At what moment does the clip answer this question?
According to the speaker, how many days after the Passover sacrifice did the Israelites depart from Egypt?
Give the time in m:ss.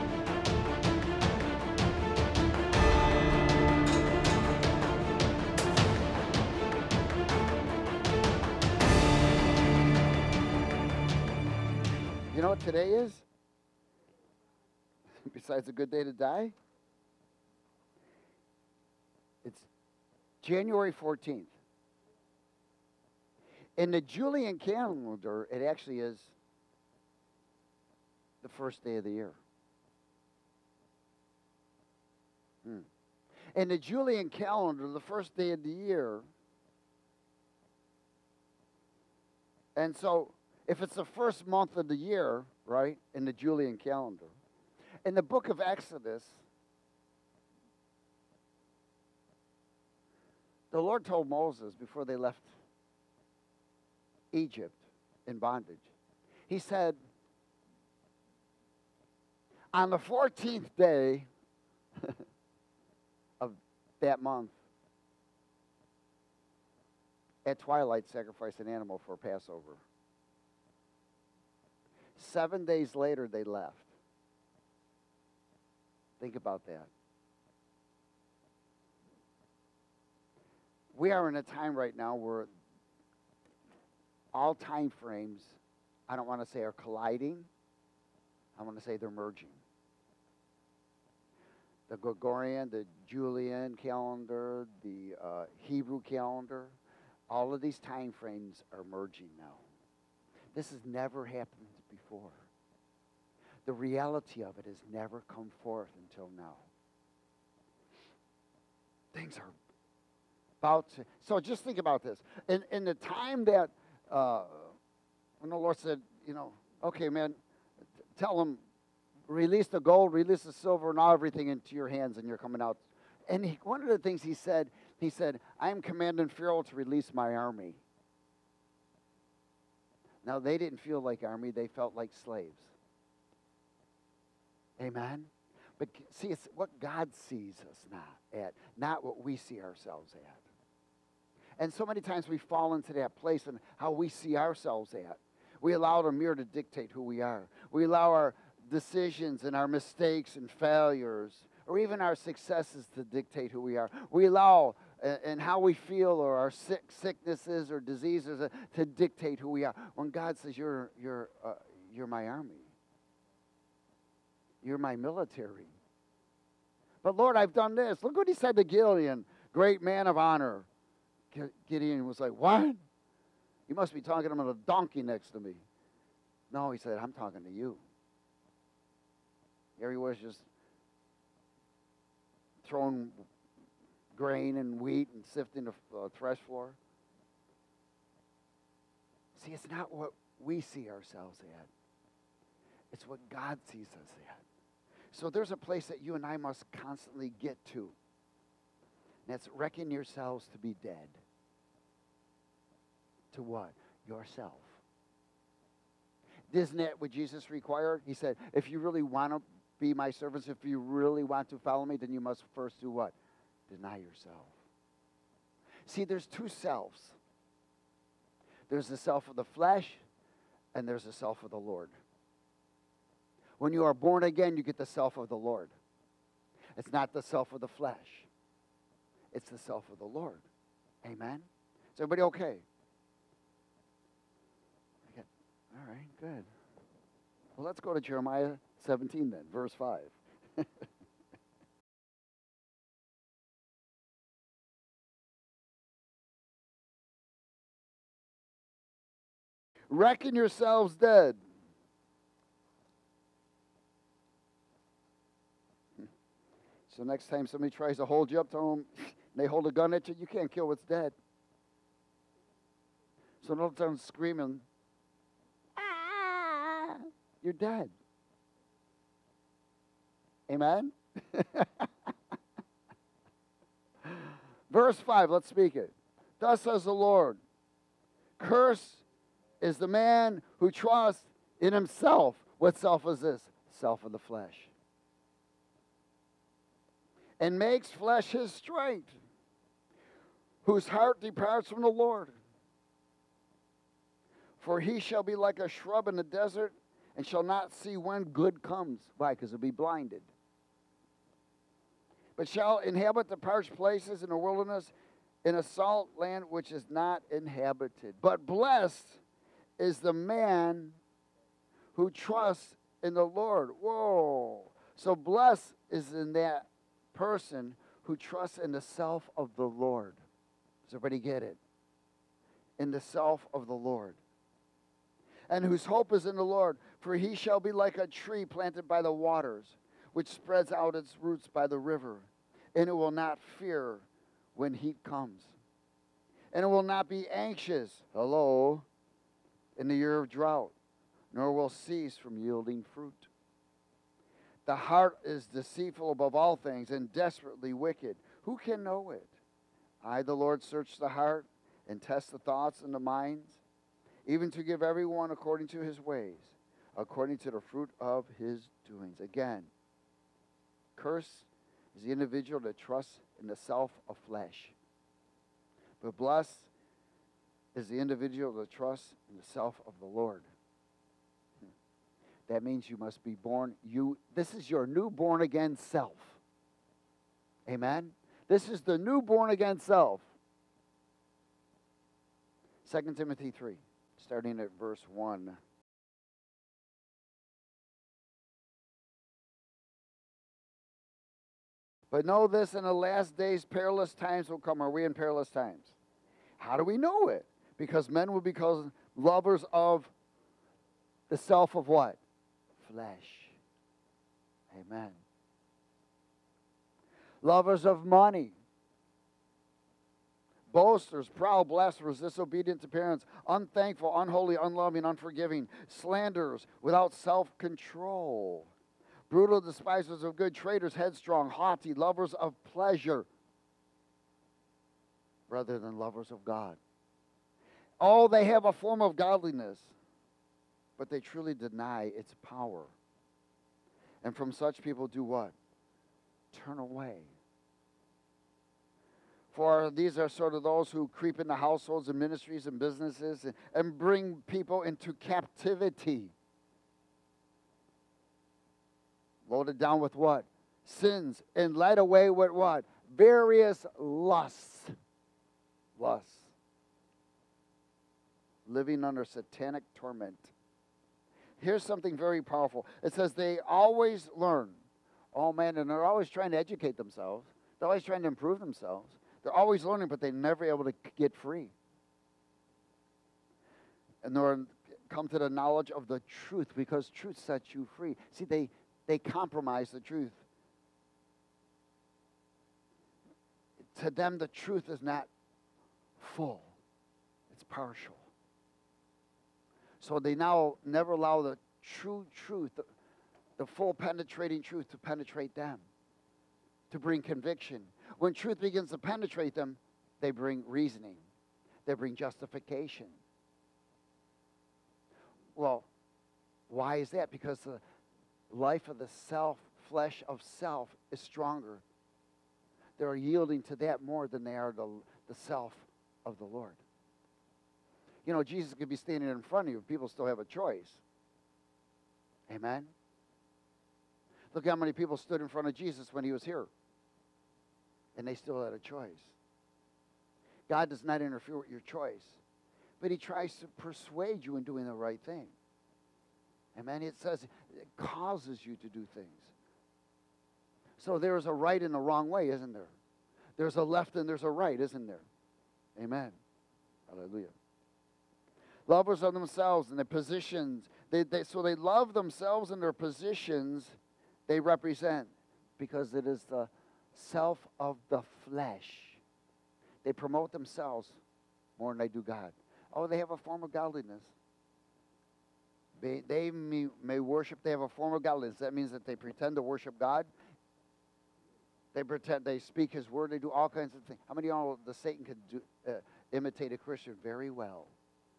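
1:12.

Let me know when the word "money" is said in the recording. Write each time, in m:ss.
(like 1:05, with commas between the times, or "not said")
6:48.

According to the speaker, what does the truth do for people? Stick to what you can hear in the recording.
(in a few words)
Sets you free.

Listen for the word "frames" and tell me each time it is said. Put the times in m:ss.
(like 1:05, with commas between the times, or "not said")
1:24, 1:38.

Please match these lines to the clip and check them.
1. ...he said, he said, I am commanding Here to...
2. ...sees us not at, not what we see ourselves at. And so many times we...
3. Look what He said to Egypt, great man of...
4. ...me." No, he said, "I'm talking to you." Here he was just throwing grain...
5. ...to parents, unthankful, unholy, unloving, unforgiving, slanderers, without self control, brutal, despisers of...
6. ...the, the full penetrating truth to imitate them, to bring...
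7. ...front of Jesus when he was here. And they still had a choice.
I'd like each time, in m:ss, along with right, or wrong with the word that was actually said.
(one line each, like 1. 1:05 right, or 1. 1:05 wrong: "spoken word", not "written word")
1. 2:04 wrong: "Pharaoh", not "Here"
2. 2:17 right
3. 2:48 wrong: "Gideon", not "Egypt"
4. 2:55 right
5. 6:52 right
6. 8:12 wrong: "penetrate", not "imitate"
7. 8:45 right.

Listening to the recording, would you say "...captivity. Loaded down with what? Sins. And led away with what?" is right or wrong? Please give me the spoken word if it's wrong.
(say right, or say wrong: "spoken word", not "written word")
right.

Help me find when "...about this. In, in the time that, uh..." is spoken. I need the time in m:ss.
1:51.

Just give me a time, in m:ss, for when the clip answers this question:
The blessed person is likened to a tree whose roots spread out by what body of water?
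5:31.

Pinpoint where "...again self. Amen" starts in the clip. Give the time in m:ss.
6:15.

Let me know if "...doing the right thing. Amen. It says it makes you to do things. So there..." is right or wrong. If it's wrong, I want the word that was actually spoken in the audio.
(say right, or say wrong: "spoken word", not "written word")
wrong: "causes", not "makes".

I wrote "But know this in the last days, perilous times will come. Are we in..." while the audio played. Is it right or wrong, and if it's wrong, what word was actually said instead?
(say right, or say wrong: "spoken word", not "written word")
right.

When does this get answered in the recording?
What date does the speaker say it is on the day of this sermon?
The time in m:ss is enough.
0:20.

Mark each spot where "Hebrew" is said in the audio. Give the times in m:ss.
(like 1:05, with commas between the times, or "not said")
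1:35.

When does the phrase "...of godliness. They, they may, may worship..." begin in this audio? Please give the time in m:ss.
9:23.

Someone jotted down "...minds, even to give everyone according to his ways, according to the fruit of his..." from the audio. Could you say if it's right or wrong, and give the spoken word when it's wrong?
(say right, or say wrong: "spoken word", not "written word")
right.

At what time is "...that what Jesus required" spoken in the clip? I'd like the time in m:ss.
3:26.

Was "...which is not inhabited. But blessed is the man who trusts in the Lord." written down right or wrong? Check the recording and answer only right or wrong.
right.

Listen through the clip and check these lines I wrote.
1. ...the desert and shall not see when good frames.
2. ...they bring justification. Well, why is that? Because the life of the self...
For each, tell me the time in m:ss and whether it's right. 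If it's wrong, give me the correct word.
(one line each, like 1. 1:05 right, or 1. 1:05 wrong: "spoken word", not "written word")
1. 4:56 wrong: "comes", not "frames"
2. 8:21 right.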